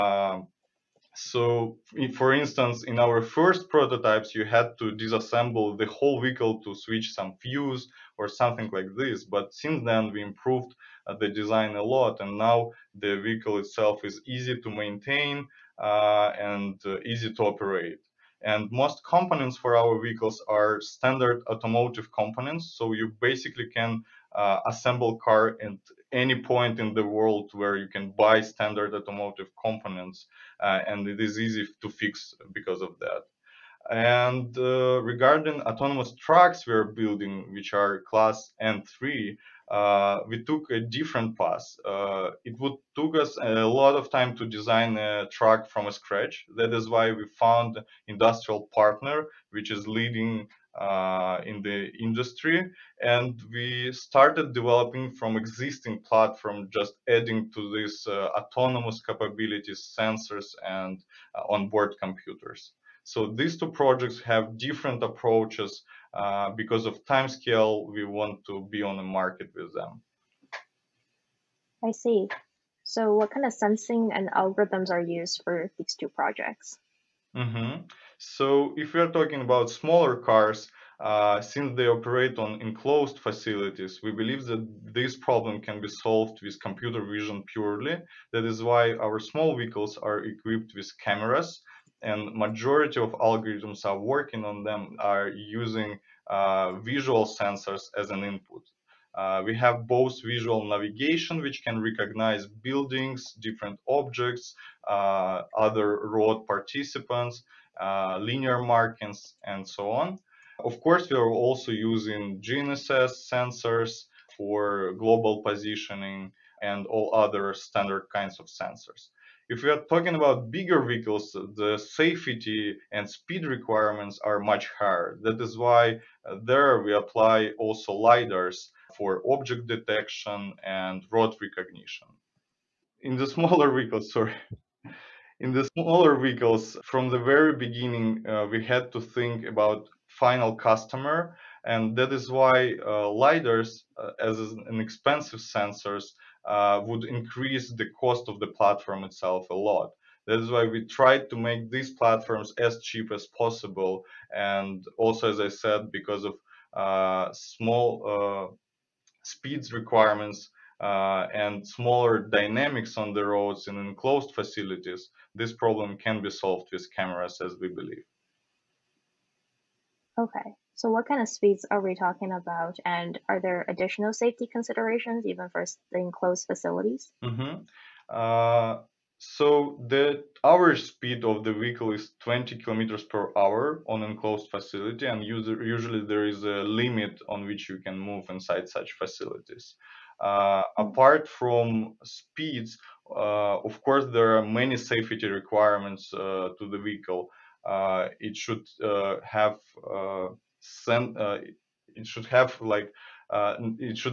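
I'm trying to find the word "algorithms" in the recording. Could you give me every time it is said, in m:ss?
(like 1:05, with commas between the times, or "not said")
1:14, 1:33.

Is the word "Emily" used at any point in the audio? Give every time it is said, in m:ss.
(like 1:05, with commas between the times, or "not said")
not said.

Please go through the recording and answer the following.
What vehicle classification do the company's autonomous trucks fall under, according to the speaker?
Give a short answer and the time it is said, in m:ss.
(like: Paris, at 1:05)
N3, at 0:38.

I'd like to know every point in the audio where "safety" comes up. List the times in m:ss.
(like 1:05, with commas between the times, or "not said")
2:01, 2:54, 3:14.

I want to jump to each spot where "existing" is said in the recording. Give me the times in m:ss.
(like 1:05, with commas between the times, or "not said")
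0:55.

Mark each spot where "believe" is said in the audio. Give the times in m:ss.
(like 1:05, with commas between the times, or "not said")
1:24, 2:47.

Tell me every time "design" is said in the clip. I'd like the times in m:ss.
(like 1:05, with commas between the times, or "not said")
0:11, 0:44.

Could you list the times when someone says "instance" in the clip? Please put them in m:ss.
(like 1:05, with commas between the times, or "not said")
0:02.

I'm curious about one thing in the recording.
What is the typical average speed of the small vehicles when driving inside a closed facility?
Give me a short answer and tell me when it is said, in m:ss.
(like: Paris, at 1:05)
20 km/h, at 3:02.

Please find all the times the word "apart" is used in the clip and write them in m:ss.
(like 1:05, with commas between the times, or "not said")
3:10.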